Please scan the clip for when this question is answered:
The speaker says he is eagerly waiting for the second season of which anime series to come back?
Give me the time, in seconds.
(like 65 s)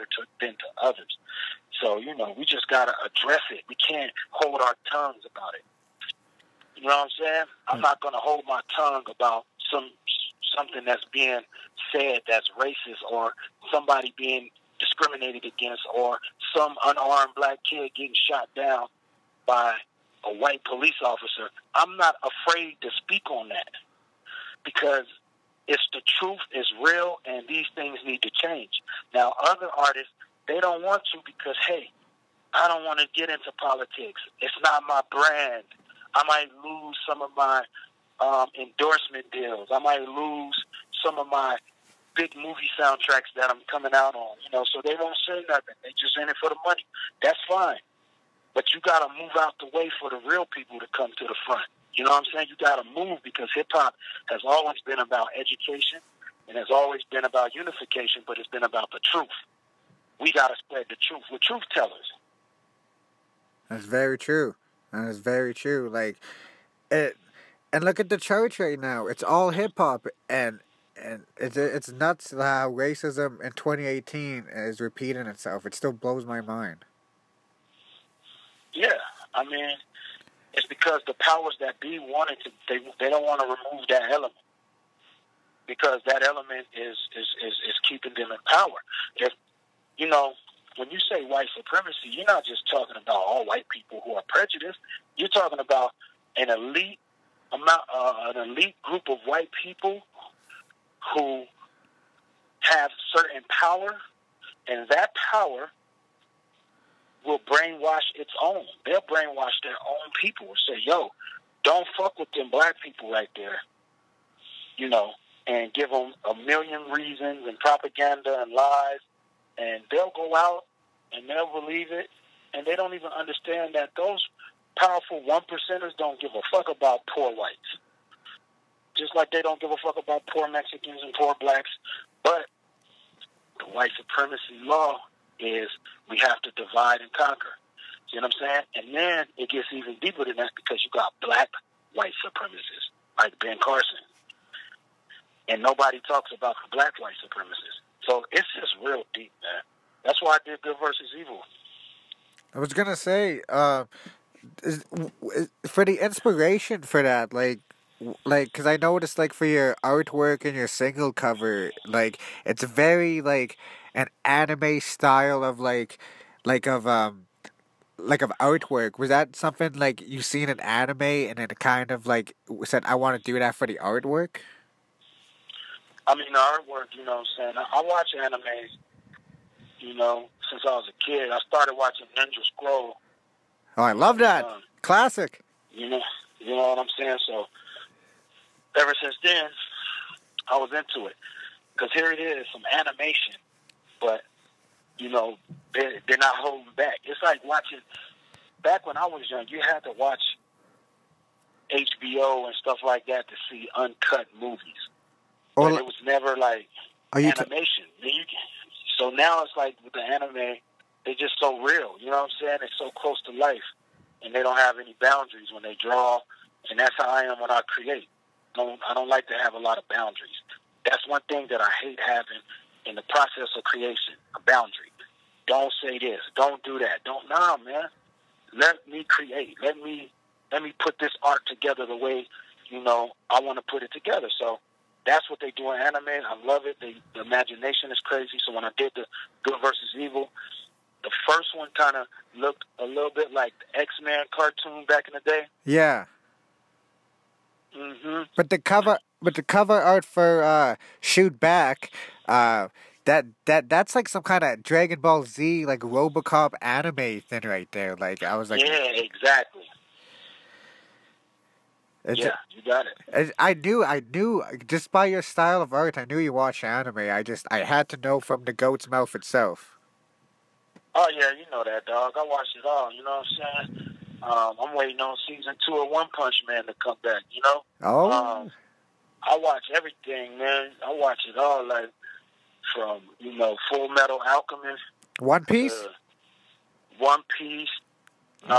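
275 s.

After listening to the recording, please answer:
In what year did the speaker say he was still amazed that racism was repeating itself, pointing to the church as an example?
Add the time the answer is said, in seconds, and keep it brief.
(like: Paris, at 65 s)
2018, at 73 s.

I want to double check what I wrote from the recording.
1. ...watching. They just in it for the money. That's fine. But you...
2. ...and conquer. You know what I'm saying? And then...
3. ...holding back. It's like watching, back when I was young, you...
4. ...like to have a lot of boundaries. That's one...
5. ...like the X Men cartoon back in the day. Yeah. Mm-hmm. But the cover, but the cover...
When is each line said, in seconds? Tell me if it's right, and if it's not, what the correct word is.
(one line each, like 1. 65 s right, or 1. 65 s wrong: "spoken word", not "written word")
1. 45 s wrong: "nothing", not "watching"
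2. 136 s right
3. 196 s right
4. 219 s right
5. 243 s right.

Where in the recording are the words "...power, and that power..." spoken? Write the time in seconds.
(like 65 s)
103 s.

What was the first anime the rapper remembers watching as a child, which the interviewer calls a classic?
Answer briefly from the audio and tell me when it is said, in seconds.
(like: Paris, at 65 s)
Ninja Scroll, at 182 s.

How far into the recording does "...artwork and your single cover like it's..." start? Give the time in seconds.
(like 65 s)
159 s.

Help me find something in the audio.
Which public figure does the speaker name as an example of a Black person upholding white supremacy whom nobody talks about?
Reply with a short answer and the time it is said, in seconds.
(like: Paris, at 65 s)
Ben Carson, at 143 s.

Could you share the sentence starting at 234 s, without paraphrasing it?
So that's what they do in anime.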